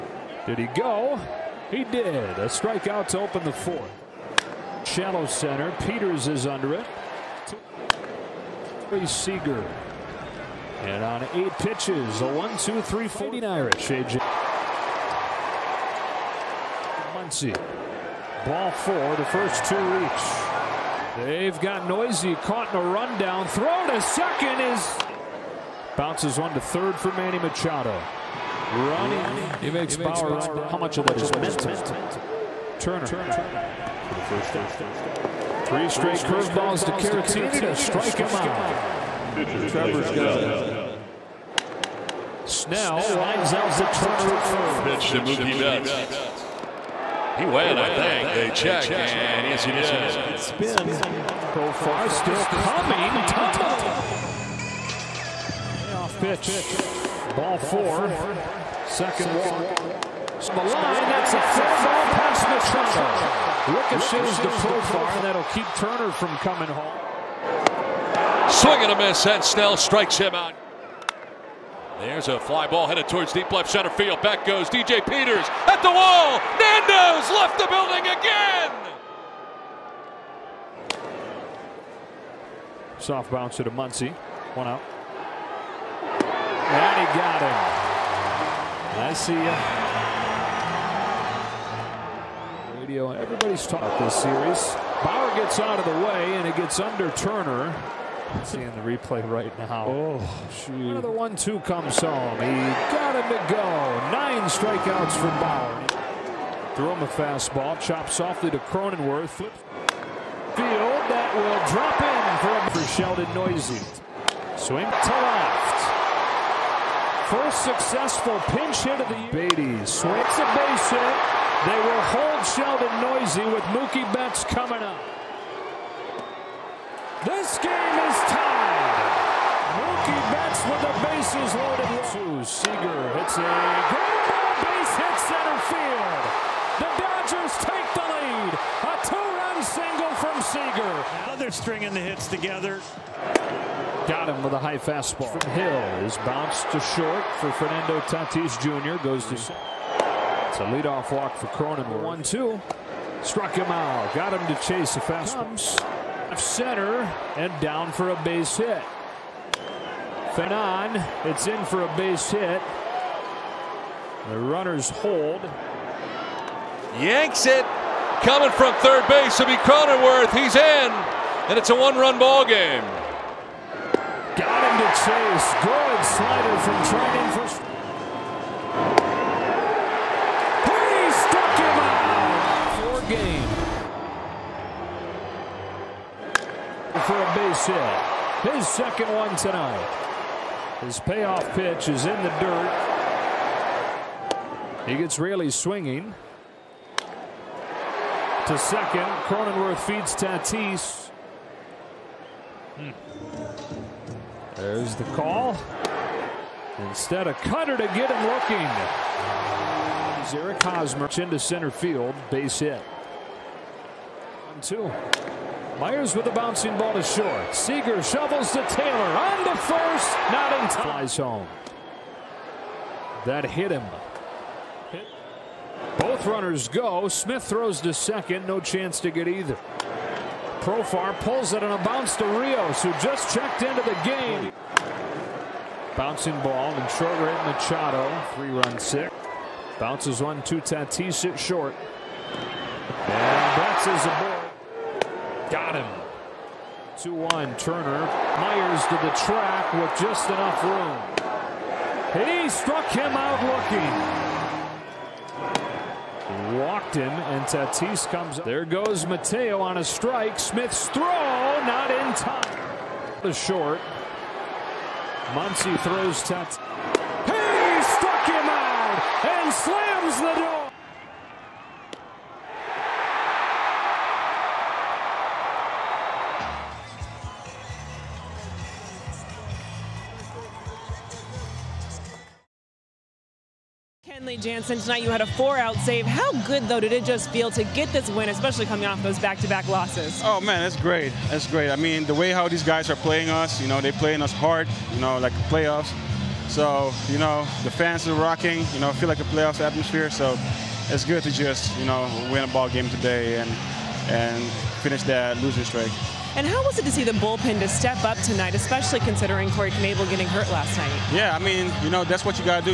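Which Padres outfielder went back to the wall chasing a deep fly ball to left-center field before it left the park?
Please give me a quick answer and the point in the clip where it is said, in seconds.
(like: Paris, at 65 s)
DJ Peters, at 74 s.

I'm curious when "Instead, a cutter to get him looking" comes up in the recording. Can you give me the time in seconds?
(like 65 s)
206 s.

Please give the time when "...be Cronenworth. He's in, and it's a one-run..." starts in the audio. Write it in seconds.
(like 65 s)
169 s.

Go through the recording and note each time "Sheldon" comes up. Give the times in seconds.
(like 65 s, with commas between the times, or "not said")
112 s, 122 s.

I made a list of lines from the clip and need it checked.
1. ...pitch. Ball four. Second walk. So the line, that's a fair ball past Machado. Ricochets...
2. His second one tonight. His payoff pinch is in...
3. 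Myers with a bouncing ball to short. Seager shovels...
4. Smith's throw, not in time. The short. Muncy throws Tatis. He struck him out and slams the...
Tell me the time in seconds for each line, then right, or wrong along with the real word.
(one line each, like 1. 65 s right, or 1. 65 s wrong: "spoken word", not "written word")
1. 56 s right
2. 188 s wrong: "pitch", not "pinch"
3. 215 s right
4. 260 s right.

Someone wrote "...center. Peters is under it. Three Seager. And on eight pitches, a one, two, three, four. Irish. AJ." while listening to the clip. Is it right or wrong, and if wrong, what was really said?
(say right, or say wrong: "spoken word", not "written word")
right.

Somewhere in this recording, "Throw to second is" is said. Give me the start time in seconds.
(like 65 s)
23 s.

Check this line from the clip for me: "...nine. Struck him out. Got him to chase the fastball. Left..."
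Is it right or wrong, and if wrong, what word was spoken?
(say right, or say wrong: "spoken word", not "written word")
wrong: "two", not "nine".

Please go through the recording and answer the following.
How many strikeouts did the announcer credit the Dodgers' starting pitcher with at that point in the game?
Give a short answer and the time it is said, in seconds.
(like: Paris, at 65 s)
9, at 104 s.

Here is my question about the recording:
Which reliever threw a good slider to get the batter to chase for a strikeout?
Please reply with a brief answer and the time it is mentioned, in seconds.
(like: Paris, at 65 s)
Treinen, at 176 s.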